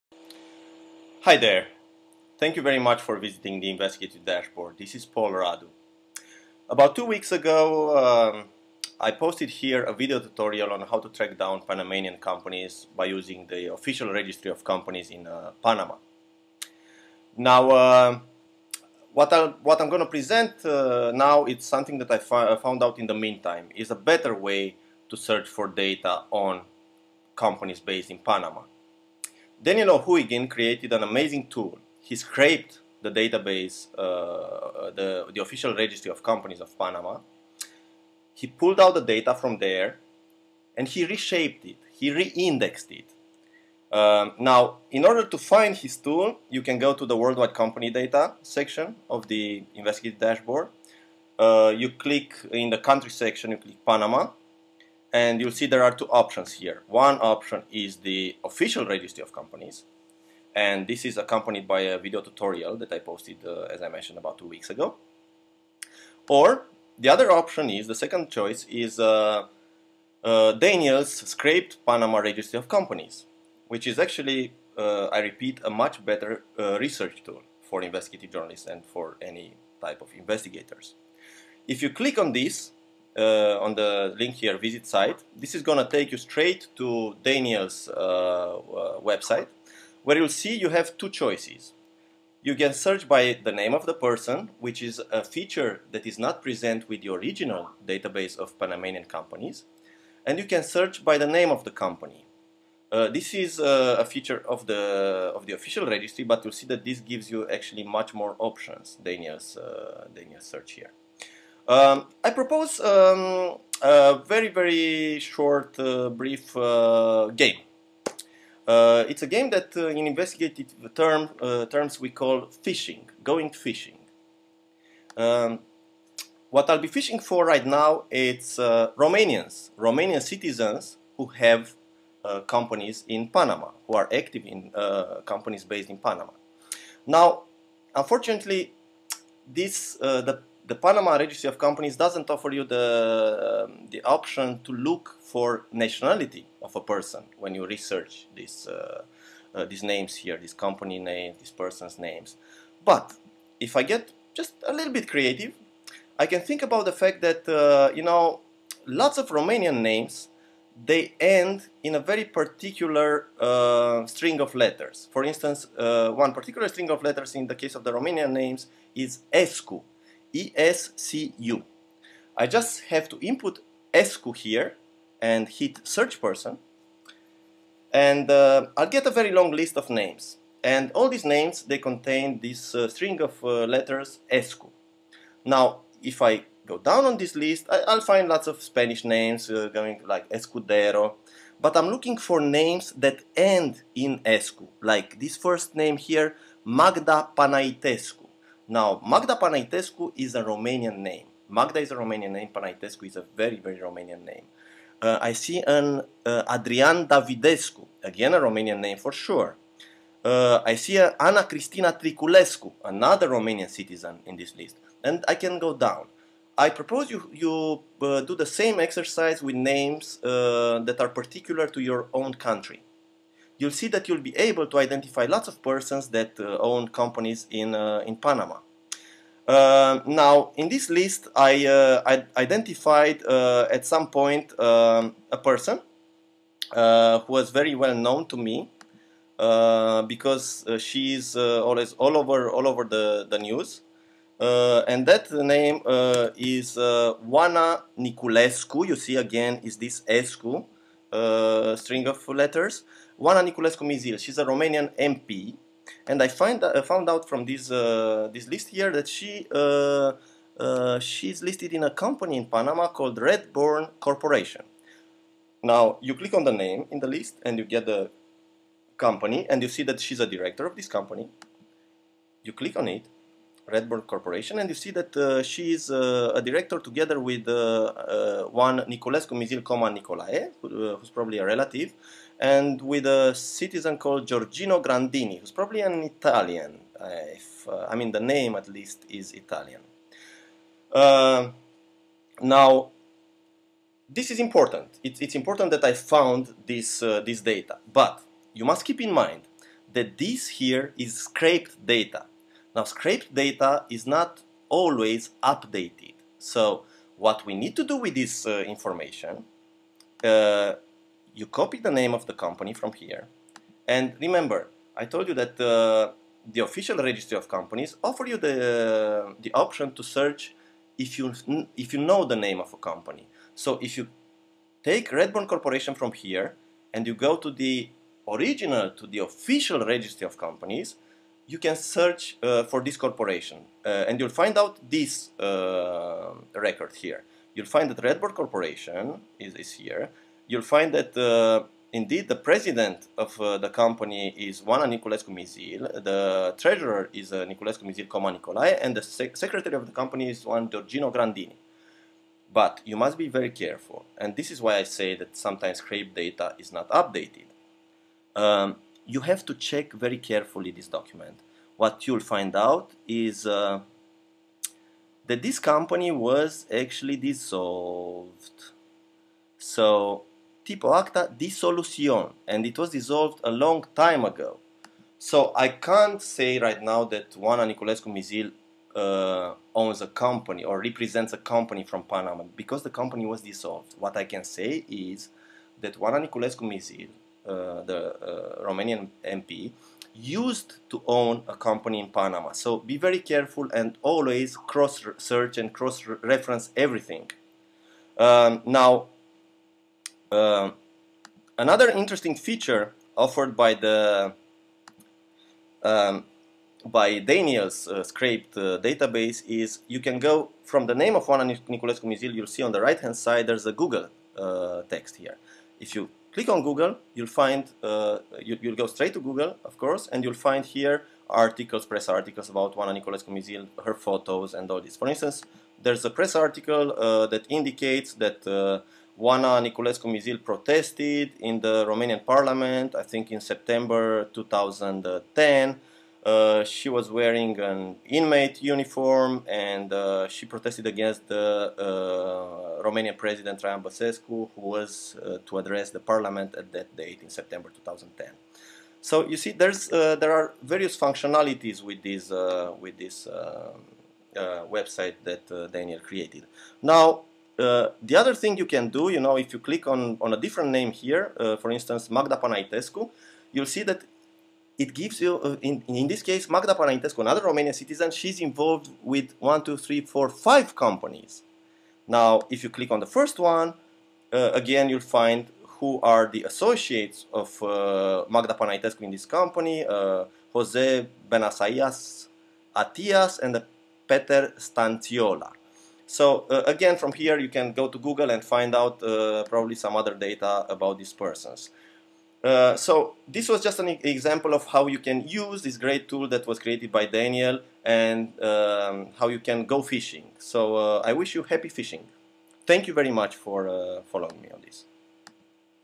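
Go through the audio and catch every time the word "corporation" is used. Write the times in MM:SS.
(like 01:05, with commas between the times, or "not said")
04:23, 04:34, 05:25, 05:32, 05:38.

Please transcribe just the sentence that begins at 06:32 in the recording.
So be very careful and always cross search and cross reference everything.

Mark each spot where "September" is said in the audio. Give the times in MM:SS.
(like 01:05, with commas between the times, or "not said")
07:13, 07:27.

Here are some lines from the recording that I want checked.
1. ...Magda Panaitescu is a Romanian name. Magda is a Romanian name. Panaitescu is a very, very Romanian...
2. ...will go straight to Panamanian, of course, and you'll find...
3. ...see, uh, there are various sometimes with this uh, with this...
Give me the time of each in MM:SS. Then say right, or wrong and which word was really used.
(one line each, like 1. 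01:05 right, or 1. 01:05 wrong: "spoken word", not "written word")
1. 03:19 right
2. 06:58 wrong: "Google", not "Panamanian"
3. 07:29 wrong: "functionalities", not "sometimes".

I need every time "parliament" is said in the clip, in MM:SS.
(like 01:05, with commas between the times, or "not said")
07:12, 07:25.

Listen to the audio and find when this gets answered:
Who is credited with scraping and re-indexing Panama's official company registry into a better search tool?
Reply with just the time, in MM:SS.
00:29.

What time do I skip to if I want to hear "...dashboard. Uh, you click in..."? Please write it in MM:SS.
00:50.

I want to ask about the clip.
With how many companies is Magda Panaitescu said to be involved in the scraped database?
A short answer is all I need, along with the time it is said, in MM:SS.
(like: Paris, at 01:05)
5, at 07:50.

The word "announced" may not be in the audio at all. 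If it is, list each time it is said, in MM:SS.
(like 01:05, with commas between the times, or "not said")
not said.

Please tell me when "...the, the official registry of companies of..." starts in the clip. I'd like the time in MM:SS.
00:34.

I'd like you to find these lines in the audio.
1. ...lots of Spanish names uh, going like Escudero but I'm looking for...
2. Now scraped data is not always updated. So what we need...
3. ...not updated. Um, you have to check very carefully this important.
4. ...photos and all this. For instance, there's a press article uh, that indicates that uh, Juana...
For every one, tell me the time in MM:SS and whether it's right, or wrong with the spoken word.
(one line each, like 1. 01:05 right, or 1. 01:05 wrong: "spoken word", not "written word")
1. 03:08 right
2. 05:02 right
3. 05:56 wrong: "document", not "important"
4. 07:03 right.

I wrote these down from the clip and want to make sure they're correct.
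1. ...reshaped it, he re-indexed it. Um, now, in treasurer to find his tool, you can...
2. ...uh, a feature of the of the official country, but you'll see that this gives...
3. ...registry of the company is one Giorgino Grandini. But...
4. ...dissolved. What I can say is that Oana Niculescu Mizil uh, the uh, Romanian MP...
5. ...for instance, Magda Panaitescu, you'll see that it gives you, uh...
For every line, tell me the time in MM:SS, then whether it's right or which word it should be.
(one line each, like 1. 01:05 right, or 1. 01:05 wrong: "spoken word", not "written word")
1. 00:41 wrong: "order", not "treasurer"
2. 01:43 wrong: "registry", not "country"
3. 05:49 wrong: "secretary", not "registry"
4. 06:23 right
5. 07:41 right.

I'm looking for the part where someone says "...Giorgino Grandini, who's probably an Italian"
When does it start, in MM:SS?
04:44.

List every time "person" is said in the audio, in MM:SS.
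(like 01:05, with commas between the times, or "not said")
01:33, 02:26, 02:31, 02:56, 03:45, 03:55, 08:11.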